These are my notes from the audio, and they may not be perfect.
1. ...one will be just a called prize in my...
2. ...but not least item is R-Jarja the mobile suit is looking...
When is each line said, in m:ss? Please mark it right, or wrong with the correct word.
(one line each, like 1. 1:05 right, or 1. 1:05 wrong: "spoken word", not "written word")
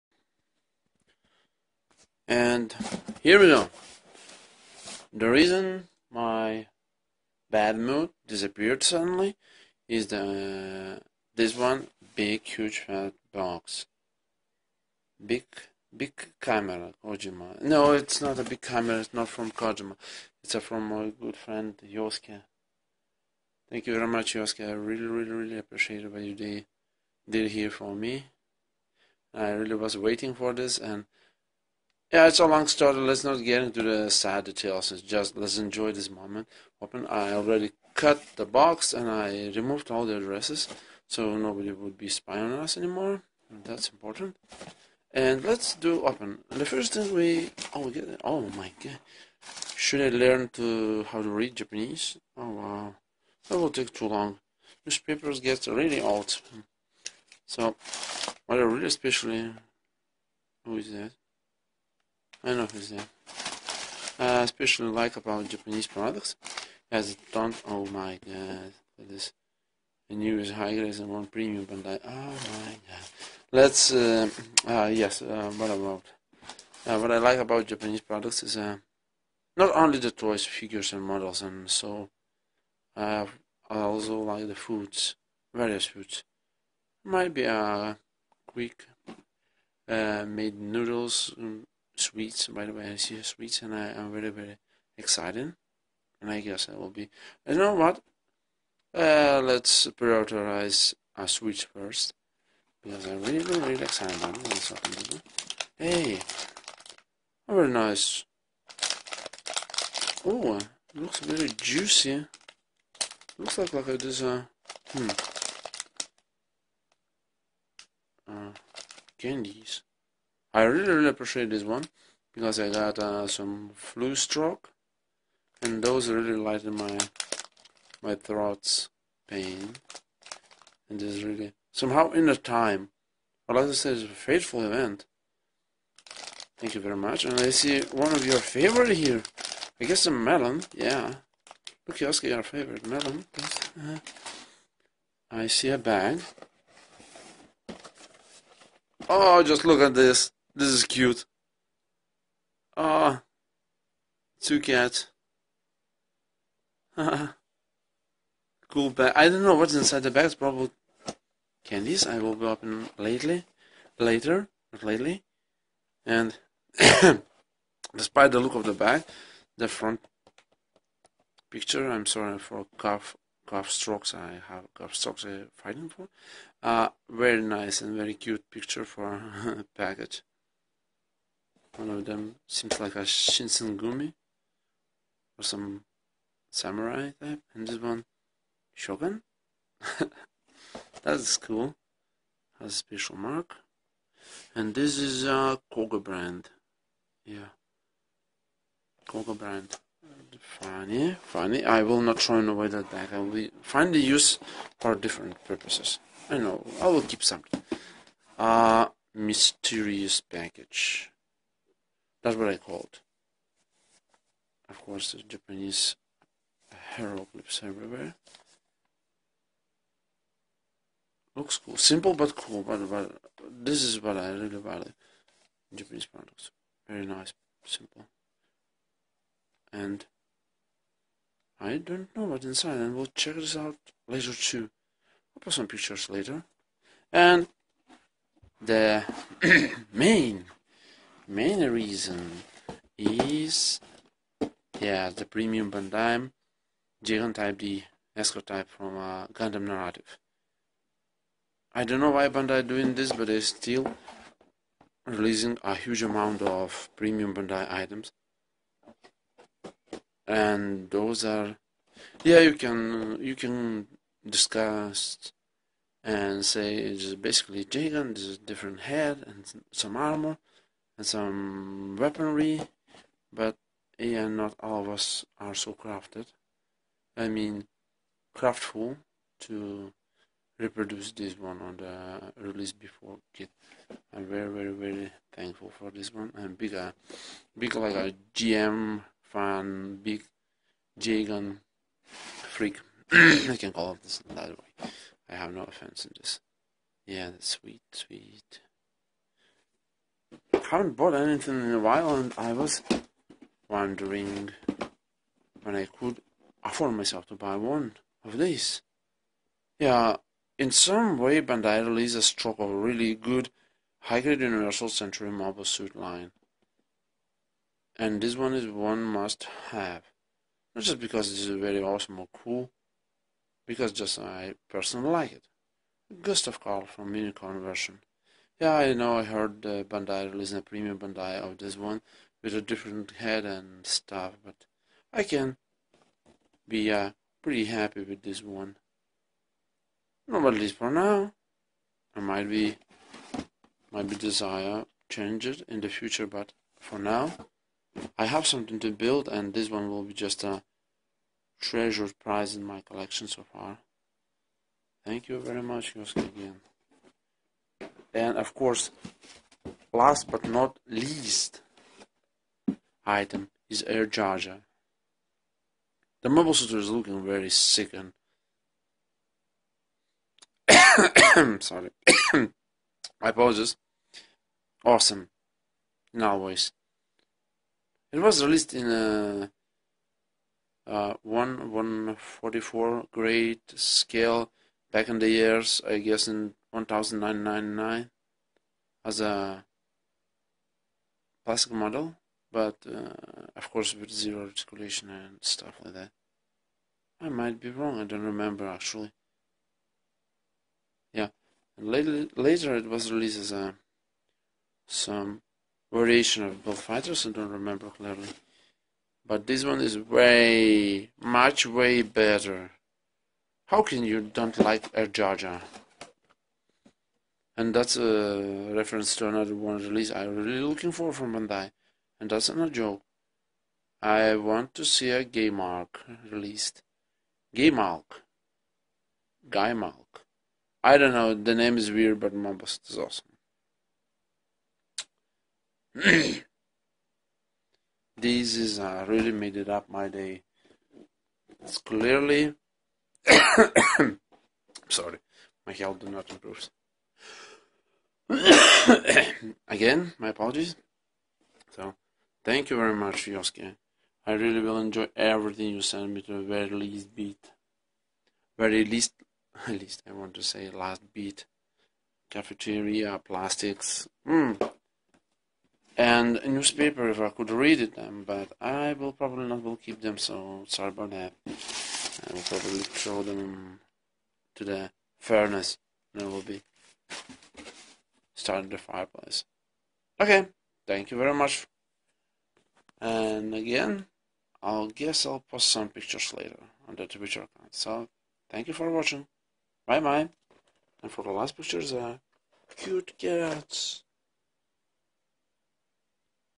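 1. 5:49 wrong: "treasured", not "called"
2. 6:00 right.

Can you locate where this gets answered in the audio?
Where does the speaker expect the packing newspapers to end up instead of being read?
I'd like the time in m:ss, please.
7:54.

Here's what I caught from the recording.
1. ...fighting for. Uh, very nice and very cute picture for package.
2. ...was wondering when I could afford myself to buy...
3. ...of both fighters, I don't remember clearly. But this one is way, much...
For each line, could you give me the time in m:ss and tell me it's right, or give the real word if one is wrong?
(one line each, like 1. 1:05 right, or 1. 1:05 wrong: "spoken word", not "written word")
1. 2:55 right
2. 5:02 right
3. 6:46 right.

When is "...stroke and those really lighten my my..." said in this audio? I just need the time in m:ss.
2:04.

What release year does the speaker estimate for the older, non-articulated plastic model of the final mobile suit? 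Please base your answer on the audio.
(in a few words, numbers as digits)
1999.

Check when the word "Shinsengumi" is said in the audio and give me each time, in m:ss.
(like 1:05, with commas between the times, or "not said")
3:03.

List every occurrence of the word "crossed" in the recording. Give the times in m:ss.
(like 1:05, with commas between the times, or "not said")
not said.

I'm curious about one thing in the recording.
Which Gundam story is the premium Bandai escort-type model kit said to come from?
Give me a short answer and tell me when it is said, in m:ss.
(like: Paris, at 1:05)
Gundam Narrative, at 4:09.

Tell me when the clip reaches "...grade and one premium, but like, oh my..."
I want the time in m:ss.
1:10.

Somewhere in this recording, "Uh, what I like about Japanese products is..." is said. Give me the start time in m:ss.
1:16.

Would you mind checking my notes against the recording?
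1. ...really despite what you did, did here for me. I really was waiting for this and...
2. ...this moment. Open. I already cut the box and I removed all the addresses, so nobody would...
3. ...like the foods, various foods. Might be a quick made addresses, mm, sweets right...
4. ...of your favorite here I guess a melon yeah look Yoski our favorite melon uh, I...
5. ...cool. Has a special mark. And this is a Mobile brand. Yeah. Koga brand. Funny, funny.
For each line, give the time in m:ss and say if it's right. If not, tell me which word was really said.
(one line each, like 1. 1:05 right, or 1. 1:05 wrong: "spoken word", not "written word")
1. 0:25 wrong: "appreciate", not "despite"
2. 0:35 right
3. 1:24 wrong: "noodles", not "addresses"
4. 2:18 right
5. 3:11 wrong: "Koga", not "Mobile".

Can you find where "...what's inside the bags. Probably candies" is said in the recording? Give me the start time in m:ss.
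2:39.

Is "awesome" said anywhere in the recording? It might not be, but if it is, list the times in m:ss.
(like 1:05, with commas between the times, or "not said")
5:21, 6:14, 7:12.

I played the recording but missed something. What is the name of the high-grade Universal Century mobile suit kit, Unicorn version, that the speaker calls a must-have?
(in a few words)
Gustav Karl.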